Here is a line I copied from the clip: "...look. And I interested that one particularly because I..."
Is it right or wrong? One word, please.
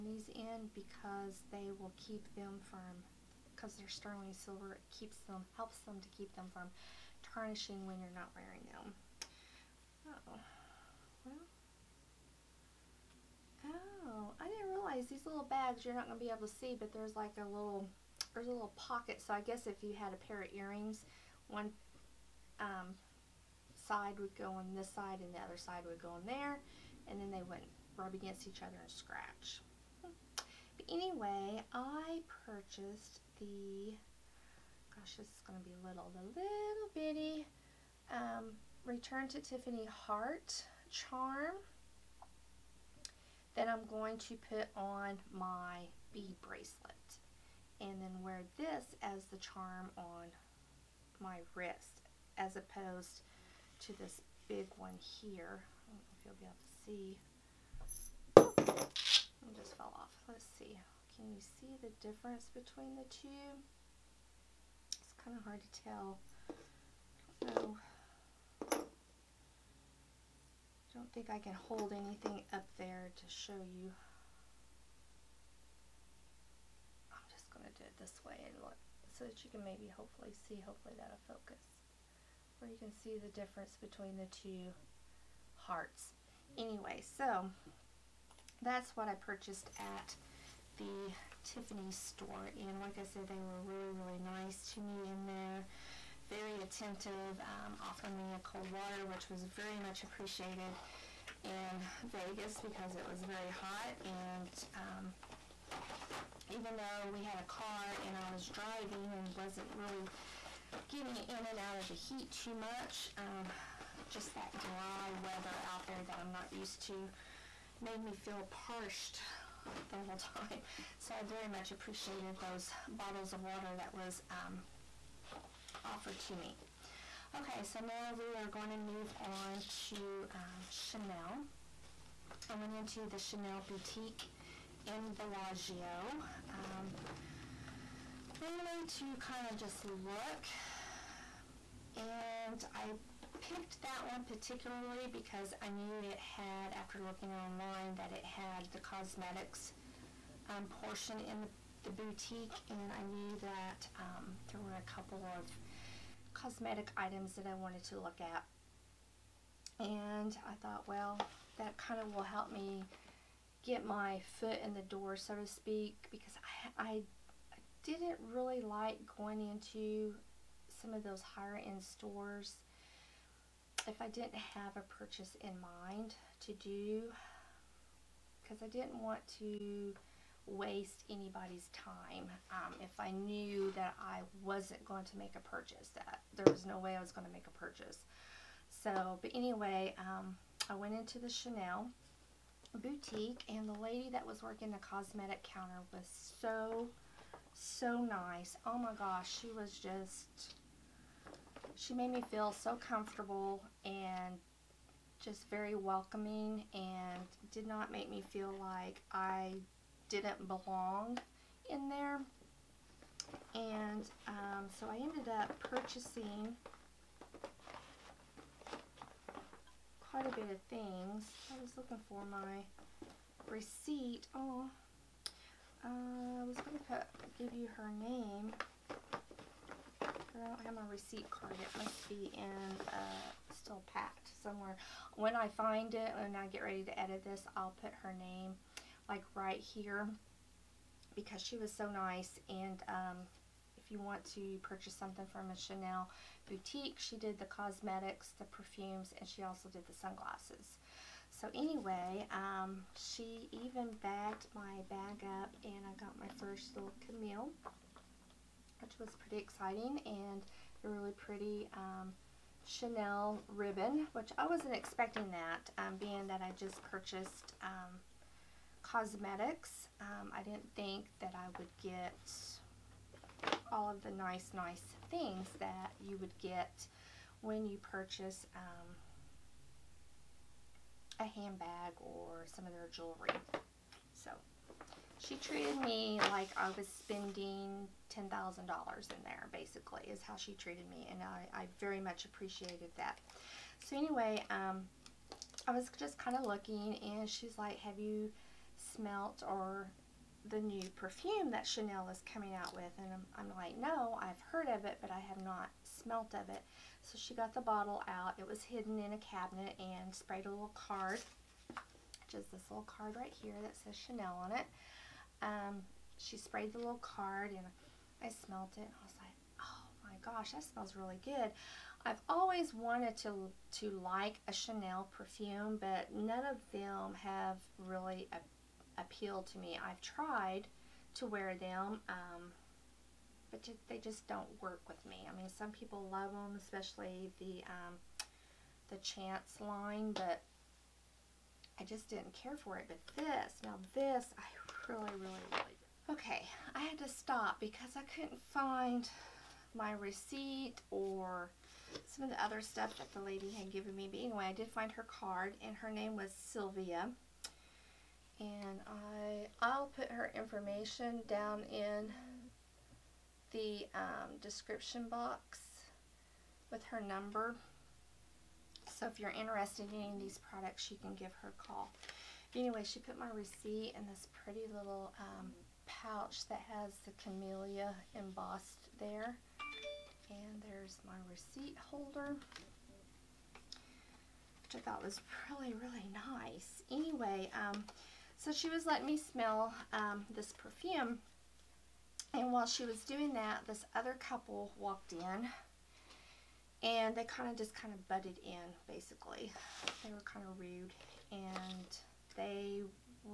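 wrong.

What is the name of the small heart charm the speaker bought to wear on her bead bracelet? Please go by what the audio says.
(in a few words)
Return to Tiffany Heart.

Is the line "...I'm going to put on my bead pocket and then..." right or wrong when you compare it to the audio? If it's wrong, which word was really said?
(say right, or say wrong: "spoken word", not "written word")
wrong: "bracelet", not "pocket".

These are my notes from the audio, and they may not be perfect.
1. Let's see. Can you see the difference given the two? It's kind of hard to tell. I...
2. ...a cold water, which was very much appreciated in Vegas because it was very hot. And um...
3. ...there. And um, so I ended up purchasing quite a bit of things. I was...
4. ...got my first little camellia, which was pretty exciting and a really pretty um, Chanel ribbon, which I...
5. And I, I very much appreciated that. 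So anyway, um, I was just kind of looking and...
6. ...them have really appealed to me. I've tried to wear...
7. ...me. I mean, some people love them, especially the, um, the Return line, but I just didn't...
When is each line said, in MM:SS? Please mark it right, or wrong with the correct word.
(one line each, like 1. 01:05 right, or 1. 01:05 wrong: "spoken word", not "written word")
1. 01:00 wrong: "between", not "given"
2. 01:38 right
3. 03:31 right
4. 04:15 right
5. 04:51 right
6. 05:26 right
7. 05:35 wrong: "Chance", not "Return".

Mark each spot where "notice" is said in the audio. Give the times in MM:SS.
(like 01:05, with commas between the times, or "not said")
not said.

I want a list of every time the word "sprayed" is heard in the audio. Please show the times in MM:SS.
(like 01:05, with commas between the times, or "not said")
05:10, 05:16.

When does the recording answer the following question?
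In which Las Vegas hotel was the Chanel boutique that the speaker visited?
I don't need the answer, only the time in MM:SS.
02:15.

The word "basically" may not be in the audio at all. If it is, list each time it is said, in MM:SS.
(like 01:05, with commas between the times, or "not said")
04:49, 06:38.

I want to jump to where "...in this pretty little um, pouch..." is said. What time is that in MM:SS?
06:13.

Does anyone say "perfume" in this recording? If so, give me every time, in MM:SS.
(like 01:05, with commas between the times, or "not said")
04:08, 05:00, 05:25, 06:30.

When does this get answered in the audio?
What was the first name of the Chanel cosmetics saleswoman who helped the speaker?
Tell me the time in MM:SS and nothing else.
05:56.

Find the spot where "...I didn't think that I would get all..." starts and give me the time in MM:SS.
04:30.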